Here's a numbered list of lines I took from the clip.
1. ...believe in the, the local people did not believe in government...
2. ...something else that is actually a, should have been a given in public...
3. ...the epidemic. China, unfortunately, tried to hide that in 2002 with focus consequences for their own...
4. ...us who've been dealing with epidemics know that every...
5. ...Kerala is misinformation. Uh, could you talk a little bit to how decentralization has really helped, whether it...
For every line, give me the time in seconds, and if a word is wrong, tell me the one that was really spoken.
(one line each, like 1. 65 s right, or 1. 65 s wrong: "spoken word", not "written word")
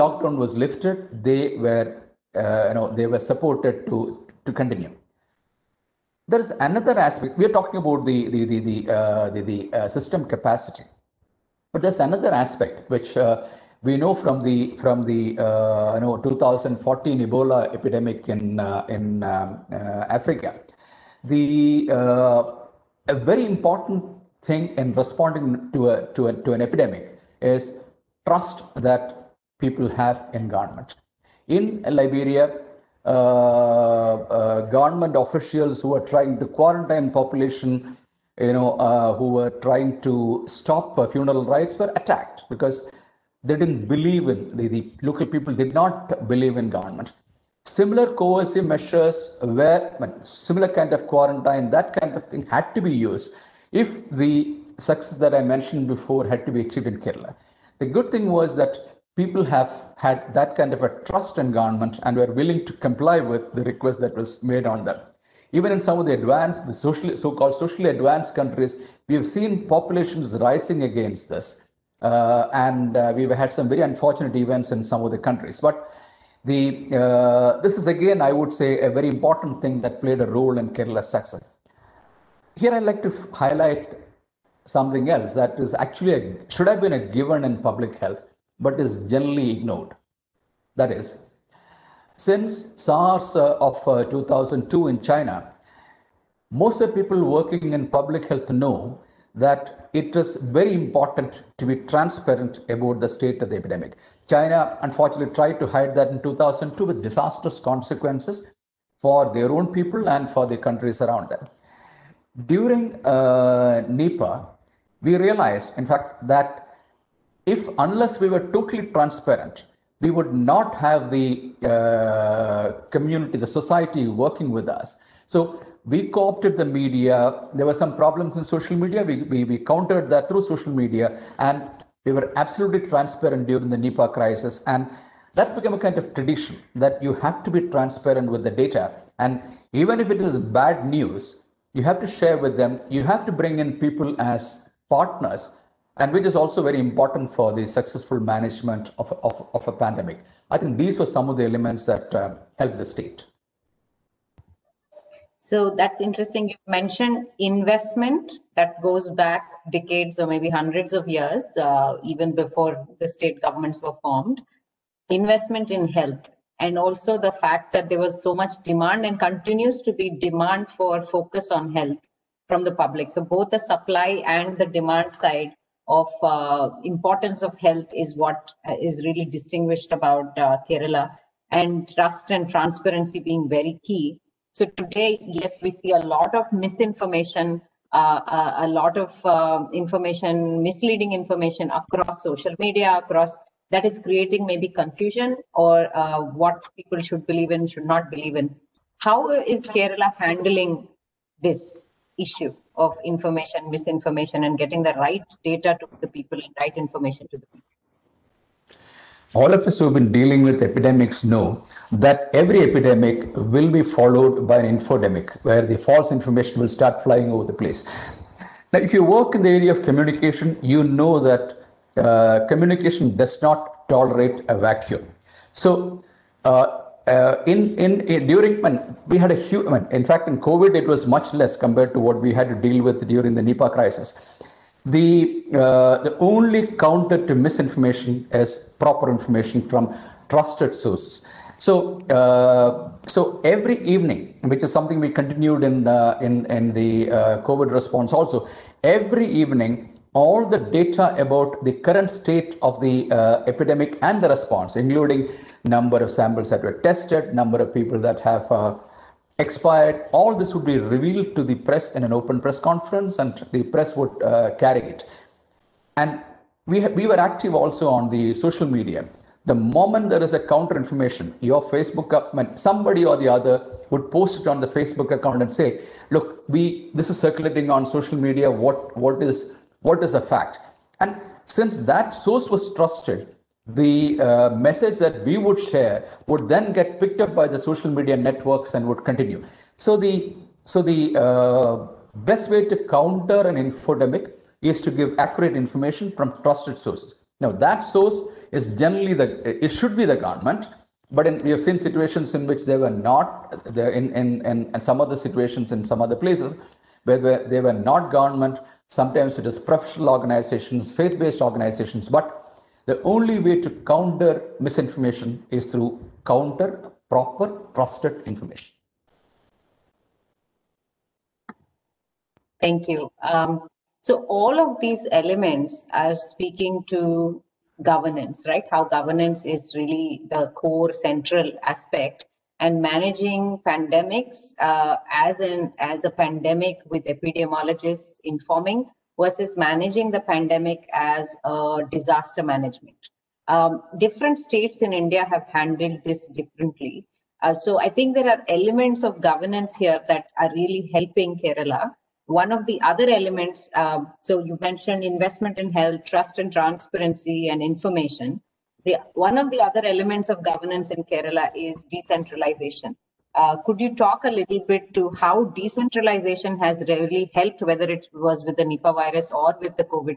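1. 43 s right
2. 84 s right
3. 103 s wrong: "disastrous", not "focus"
4. 209 s right
5. 361 s wrong: "decentralization", not "misinformation".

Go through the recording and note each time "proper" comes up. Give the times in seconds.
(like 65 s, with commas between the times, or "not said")
238 s, 317 s.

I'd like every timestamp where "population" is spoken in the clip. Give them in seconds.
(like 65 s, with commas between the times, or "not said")
37 s, 69 s.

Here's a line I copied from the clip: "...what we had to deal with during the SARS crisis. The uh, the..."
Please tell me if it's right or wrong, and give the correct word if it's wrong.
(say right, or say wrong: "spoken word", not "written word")
wrong: "Nipah", not "SARS".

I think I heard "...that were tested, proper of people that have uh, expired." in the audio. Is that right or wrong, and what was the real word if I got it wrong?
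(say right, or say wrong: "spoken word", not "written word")
wrong: "number", not "proper".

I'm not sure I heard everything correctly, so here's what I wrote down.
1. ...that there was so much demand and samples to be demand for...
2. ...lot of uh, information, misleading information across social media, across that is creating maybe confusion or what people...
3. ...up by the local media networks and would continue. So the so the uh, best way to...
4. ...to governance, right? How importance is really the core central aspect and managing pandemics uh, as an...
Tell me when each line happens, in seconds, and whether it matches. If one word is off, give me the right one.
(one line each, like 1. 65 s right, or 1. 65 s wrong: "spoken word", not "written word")
1. 167 s wrong: "continues", not "samples"
2. 188 s right
3. 287 s wrong: "social", not "local"
4. 326 s wrong: "governance", not "importance".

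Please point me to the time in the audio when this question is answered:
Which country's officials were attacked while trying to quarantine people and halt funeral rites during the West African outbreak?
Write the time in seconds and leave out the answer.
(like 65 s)
31 s.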